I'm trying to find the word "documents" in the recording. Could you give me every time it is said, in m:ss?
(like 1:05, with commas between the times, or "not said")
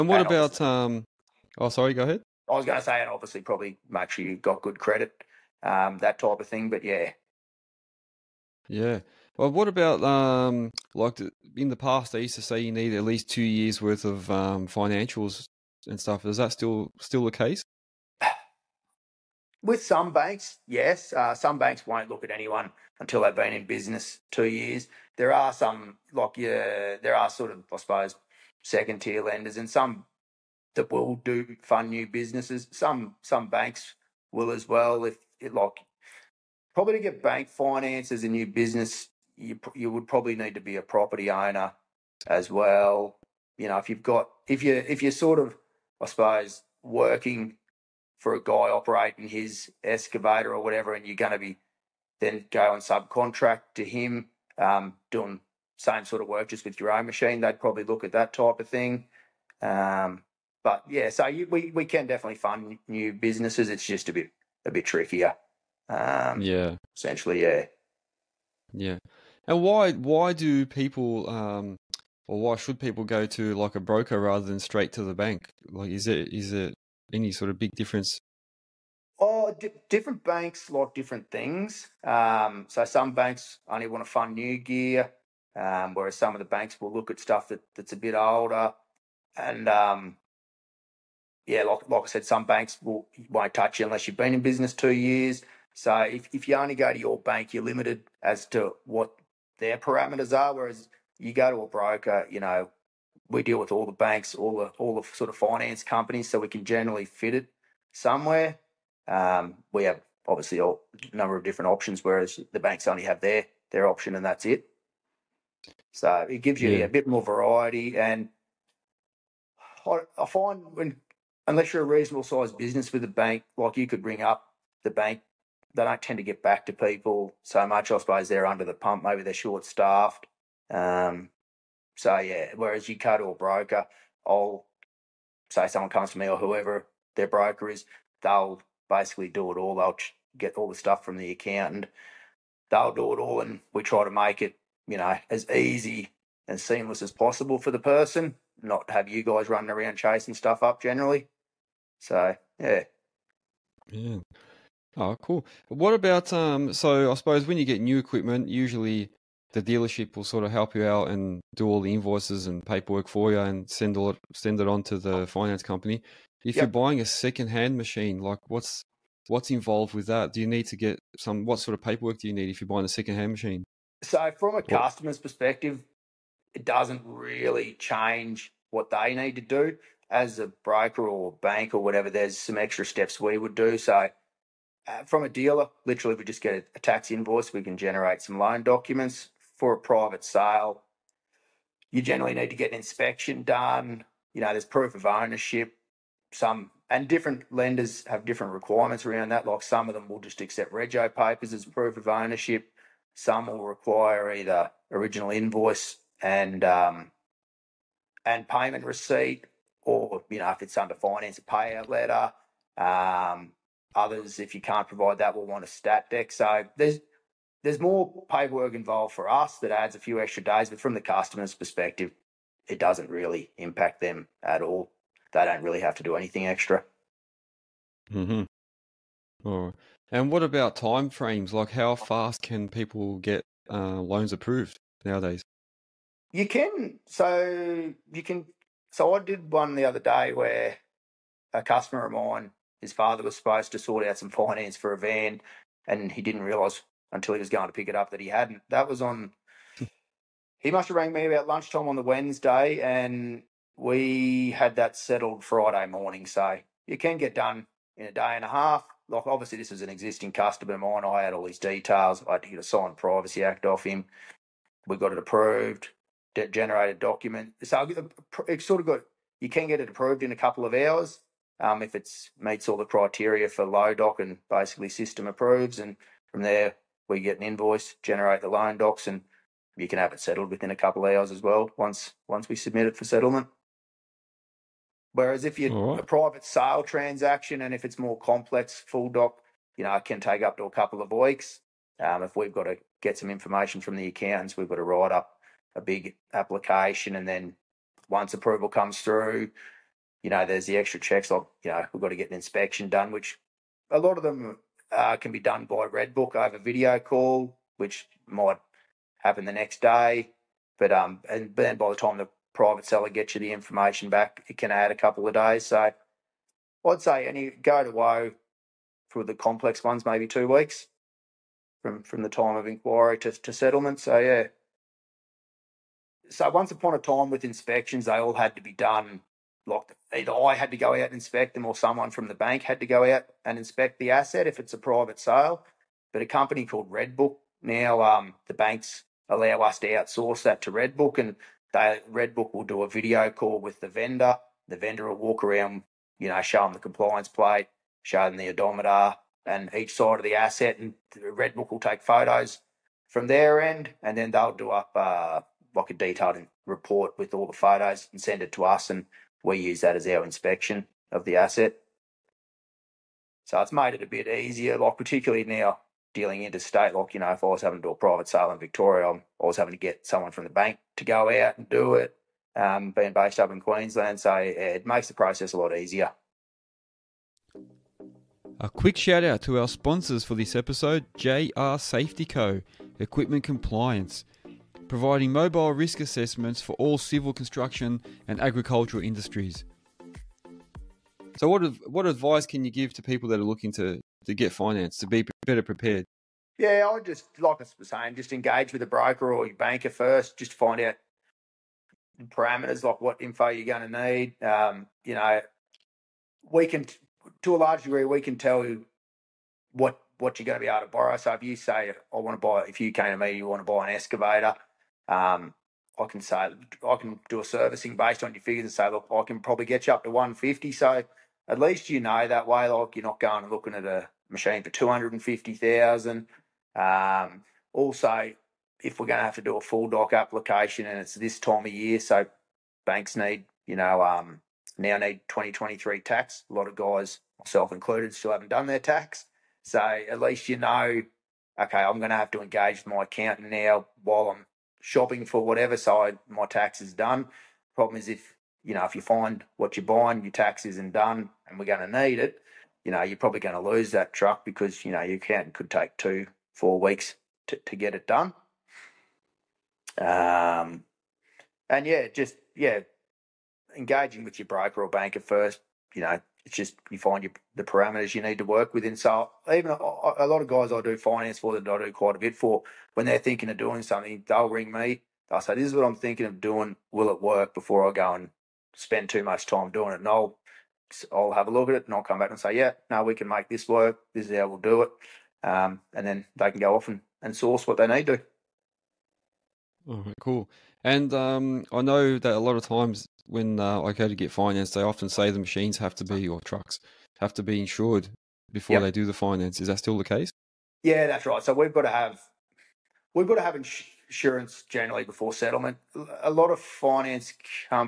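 3:08, 4:26.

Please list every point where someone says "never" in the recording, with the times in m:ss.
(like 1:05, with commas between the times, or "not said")
not said.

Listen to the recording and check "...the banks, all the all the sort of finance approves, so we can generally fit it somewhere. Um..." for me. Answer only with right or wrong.
wrong.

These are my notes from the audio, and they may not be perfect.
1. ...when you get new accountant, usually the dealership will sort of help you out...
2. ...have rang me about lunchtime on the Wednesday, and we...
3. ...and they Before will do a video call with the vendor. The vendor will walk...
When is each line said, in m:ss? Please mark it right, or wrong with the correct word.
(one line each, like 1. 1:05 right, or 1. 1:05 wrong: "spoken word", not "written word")
1. 2:37 wrong: "equipment", not "accountant"
2. 4:10 right
3. 5:41 wrong: "Redbook", not "Before".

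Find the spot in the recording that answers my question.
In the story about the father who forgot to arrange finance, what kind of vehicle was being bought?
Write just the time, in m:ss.
4:04.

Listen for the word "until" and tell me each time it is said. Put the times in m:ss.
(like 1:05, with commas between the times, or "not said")
0:22, 4:07.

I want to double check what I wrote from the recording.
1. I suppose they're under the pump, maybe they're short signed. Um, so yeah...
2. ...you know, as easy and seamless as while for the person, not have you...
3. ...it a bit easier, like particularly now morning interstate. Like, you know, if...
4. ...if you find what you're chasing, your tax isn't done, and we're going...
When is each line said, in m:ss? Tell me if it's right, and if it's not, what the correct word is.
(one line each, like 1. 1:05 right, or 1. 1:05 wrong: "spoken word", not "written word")
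1. 2:07 wrong: "staffed", not "signed"
2. 2:24 wrong: "possible", not "while"
3. 6:03 wrong: "dealing", not "morning"
4. 7:28 wrong: "buying", not "chasing".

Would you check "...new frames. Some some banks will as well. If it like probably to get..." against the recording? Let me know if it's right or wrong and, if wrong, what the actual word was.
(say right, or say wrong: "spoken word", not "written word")
wrong: "businesses", not "frames".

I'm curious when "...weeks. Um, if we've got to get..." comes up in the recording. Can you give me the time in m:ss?
4:51.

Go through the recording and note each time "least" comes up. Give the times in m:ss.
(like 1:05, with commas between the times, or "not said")
0:13, 7:01, 7:20.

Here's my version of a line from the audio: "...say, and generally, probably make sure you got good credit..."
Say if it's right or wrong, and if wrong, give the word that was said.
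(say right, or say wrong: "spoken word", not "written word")
wrong: "obviously", not "generally".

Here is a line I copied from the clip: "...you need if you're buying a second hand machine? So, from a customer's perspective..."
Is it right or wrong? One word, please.
right.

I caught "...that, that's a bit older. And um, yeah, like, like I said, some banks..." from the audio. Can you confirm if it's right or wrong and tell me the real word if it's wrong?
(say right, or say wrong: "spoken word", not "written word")
right.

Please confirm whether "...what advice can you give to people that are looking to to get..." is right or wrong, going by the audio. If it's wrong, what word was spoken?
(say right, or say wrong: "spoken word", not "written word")
right.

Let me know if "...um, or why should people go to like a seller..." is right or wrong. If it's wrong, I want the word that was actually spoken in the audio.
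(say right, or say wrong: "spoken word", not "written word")
wrong: "broker", not "seller".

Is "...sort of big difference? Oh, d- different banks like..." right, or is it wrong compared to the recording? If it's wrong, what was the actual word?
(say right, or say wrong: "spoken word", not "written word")
right.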